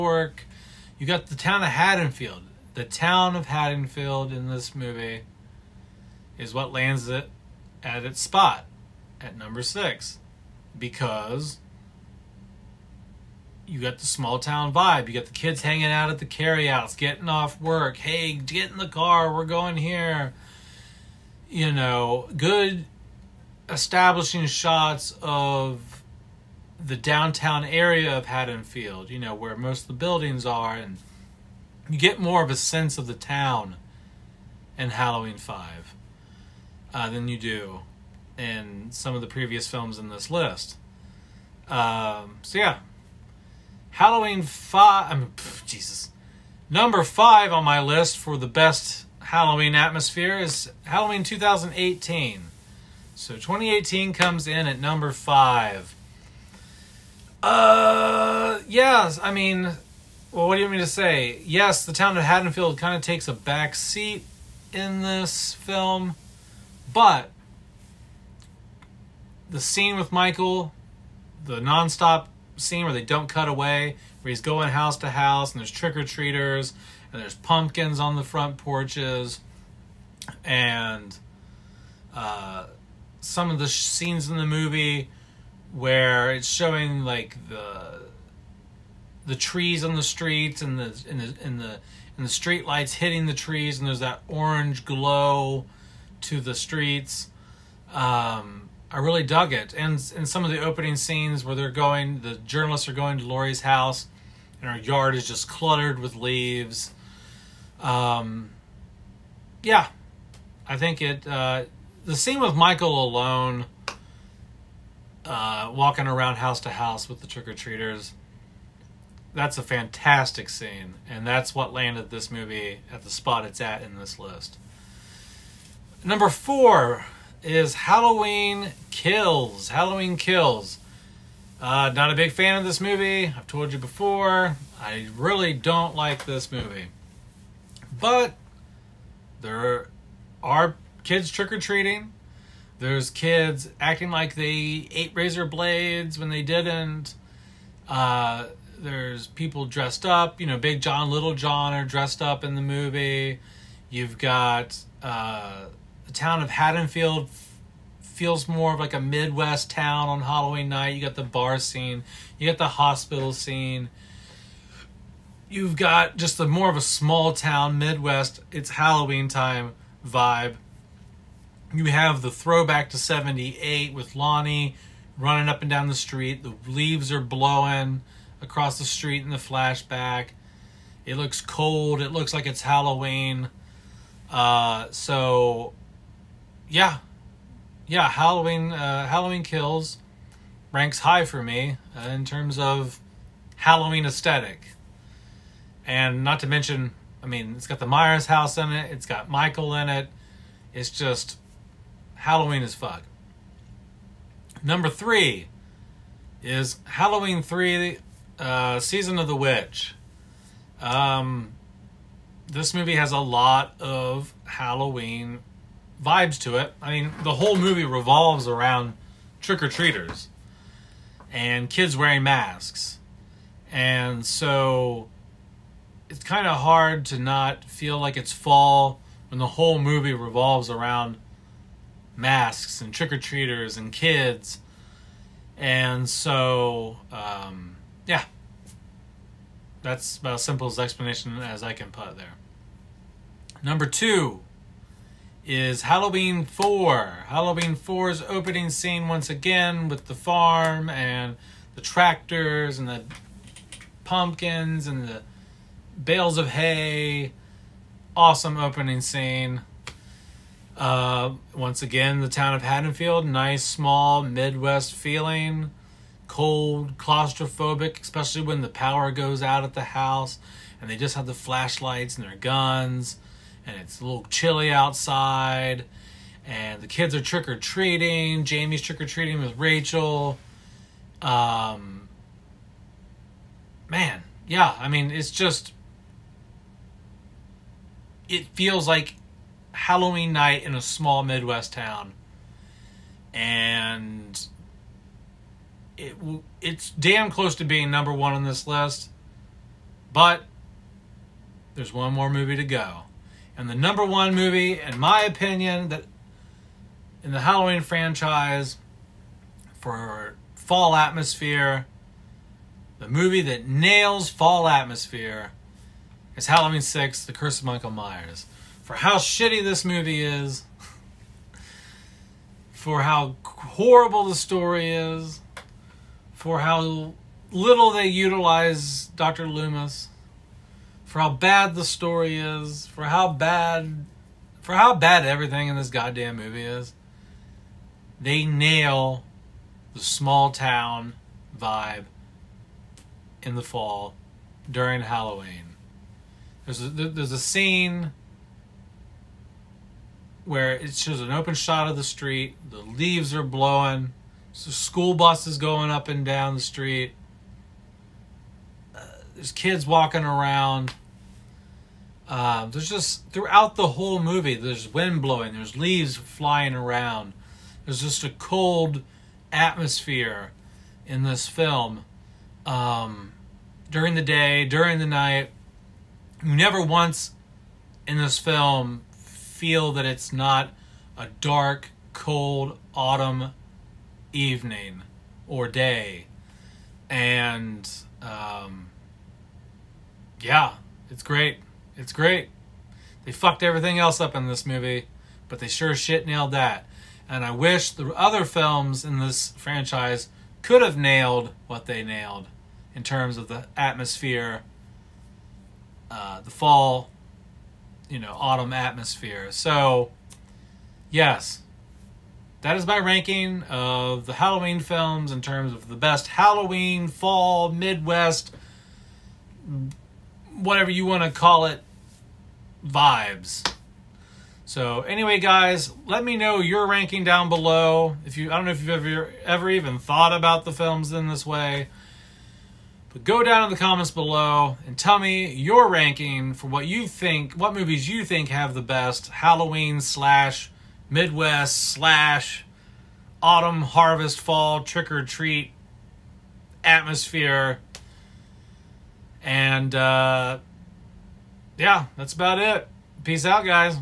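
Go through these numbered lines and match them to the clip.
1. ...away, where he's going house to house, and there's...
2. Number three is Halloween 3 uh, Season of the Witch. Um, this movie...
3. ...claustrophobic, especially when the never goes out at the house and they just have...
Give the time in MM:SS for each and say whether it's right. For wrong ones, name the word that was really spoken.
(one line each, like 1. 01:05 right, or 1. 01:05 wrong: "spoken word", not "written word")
1. 01:13 right
2. 03:24 right
3. 04:26 wrong: "power", not "never".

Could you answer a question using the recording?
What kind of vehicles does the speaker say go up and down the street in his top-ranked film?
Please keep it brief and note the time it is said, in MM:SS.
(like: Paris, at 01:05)
School buses, at 05:54.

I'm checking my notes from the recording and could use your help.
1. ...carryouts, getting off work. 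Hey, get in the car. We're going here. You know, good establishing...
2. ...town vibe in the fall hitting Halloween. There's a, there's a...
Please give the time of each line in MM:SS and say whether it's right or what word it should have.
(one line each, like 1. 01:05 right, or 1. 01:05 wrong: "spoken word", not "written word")
1. 00:16 right
2. 05:40 wrong: "during", not "hitting".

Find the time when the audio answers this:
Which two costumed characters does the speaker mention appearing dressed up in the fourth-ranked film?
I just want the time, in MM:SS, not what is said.
02:30.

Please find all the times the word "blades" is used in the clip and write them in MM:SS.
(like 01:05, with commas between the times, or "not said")
02:25.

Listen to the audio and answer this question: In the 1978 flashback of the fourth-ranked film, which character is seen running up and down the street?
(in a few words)
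Lonnie.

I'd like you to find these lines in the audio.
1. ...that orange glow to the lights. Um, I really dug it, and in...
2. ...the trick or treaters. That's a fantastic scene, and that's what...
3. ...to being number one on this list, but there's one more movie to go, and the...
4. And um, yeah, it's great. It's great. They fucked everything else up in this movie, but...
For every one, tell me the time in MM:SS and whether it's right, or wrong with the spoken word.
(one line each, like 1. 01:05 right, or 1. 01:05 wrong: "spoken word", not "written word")
1. 01:33 wrong: "streets", not "lights"
2. 01:57 right
3. 04:57 right
4. 06:27 right.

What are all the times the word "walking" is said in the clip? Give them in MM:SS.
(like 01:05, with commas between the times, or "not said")
01:55, 05:59.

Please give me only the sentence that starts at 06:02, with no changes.
Uh, there's just throughout the whole movie.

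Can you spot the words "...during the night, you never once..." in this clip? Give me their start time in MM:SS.
06:14.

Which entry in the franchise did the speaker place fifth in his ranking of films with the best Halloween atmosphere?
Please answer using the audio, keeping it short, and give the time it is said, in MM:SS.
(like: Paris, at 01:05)
Halloween 2018, at 00:50.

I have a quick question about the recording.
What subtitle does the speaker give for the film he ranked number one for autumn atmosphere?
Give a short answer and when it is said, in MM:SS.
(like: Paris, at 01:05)
The Curse of Michael Myers, at 05:17.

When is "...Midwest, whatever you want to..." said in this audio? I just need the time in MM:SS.
06:57.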